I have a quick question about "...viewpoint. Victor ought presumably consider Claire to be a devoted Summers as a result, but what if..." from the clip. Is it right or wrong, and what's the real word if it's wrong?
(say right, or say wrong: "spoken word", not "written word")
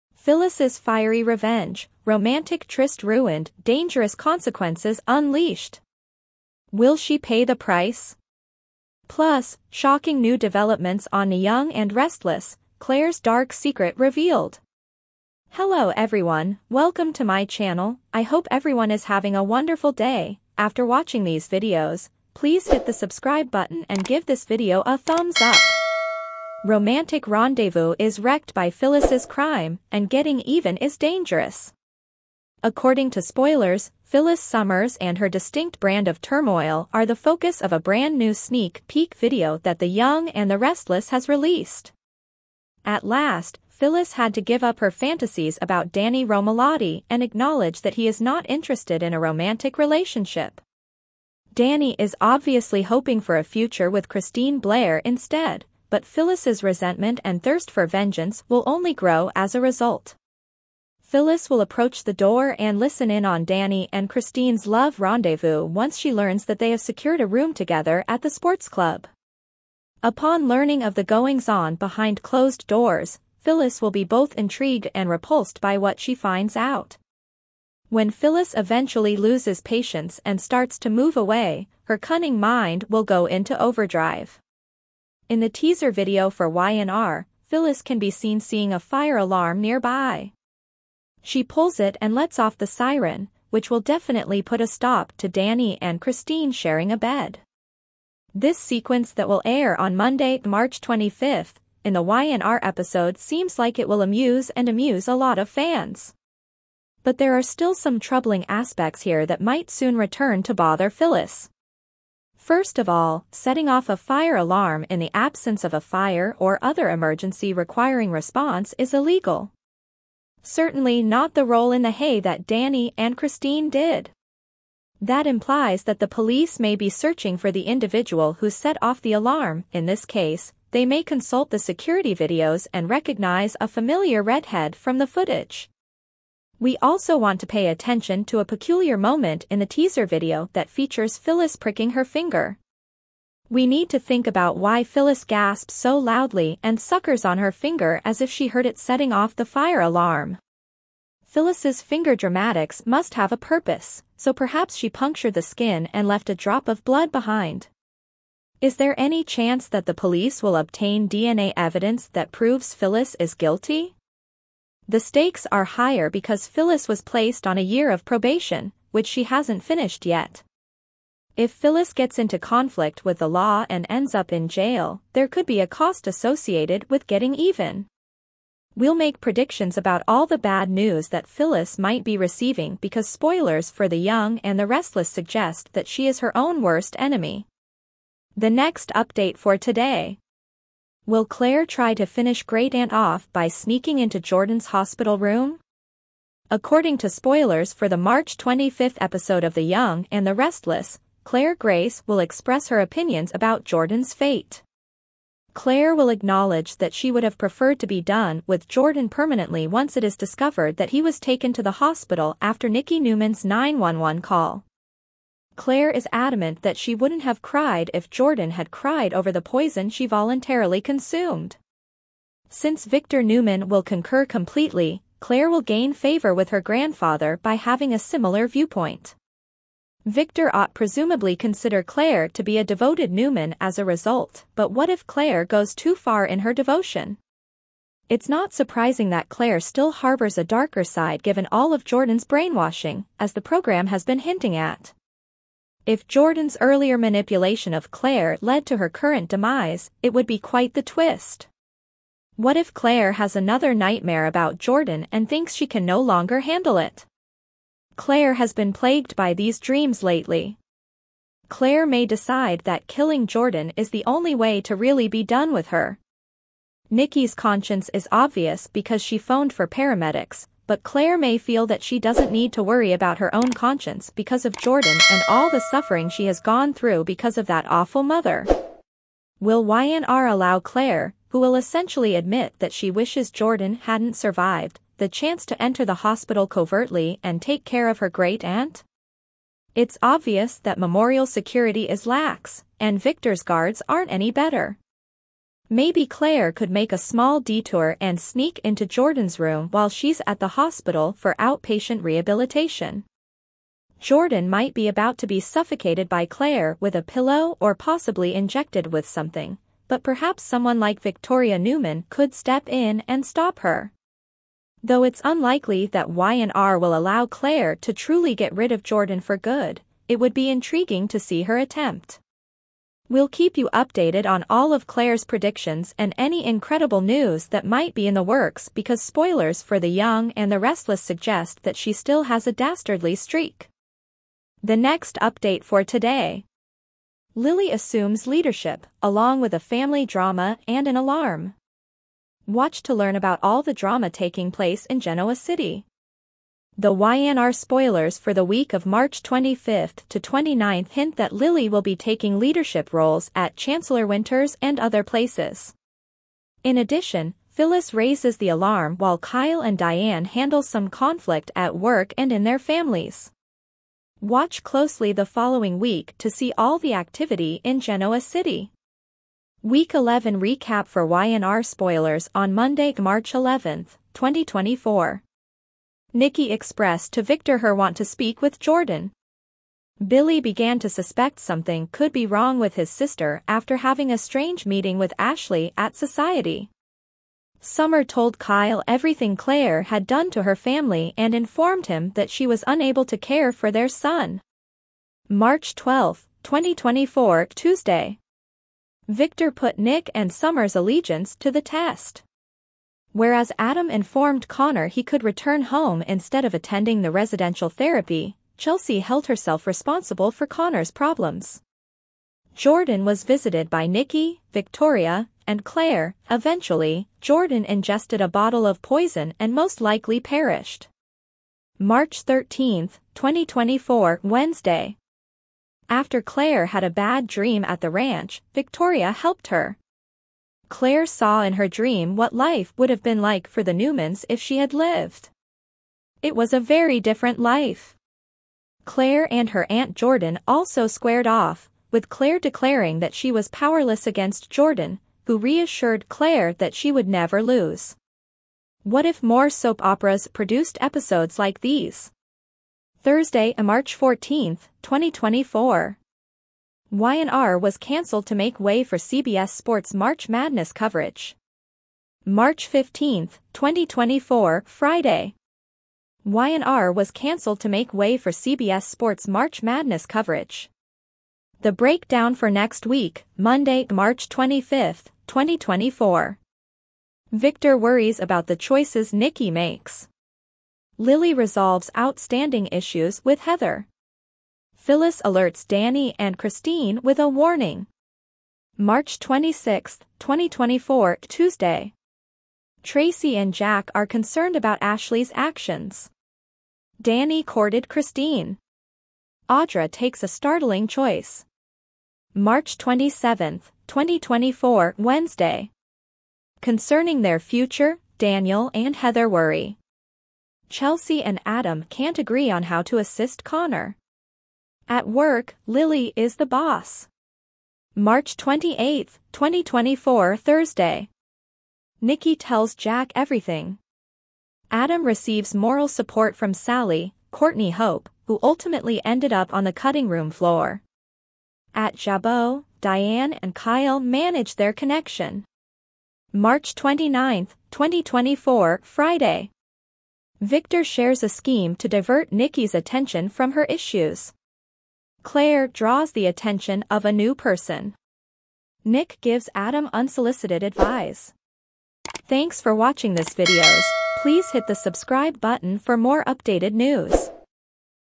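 wrong: "Newman", not "Summers".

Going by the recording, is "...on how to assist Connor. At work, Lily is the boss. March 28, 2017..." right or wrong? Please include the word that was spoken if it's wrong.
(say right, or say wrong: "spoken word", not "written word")
wrong: "2024", not "2017".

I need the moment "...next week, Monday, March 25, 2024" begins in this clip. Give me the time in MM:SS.
07:52.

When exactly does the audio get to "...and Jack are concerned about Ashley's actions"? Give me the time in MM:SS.
08:13.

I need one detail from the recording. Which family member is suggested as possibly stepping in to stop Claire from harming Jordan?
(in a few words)
Victoria Newman.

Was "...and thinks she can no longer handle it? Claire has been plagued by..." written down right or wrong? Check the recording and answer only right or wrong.
right.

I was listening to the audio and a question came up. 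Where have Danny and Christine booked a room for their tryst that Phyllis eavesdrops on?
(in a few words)
the sports club.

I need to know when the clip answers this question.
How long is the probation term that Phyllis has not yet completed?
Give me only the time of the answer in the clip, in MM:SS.
02:47.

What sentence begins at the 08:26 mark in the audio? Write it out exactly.
Concerning their future, Daniel and Heather worry.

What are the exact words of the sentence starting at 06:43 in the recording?
Whereas Adam informed Connor he could return home instead of attending the residential therapy, Chelsea held herself responsible for Connor's problems.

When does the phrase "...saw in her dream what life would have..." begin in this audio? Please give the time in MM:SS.
07:11.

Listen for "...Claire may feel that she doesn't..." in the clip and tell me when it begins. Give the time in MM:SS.
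04:30.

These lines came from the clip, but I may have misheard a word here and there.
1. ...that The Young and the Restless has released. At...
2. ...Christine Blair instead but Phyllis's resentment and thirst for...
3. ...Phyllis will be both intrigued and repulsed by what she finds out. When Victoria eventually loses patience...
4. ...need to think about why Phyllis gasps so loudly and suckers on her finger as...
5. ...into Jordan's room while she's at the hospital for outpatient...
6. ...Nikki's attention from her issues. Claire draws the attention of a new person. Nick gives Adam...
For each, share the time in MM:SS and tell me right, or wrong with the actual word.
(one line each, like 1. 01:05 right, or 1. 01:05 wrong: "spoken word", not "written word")
1. 00:39 right
2. 00:54 right
3. 01:13 wrong: "Phyllis", not "Victoria"
4. 02:23 right
5. 04:58 right
6. 09:02 right.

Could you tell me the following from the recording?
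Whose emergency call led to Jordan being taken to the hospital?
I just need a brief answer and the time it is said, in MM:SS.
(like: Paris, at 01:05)
Nikki Newman, at 03:32.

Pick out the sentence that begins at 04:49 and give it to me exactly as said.
It's obvious that memorial security is lax, and Victor's guards aren't any better.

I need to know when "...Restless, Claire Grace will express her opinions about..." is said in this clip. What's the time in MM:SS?
03:20.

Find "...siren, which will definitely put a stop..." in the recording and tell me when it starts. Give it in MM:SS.
01:32.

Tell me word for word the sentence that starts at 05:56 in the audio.
In addition, Phyllis raises the alarm while Kyle and Diane handle some conflict at work and in their families.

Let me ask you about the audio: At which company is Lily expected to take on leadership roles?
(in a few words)
Chancellor Winters.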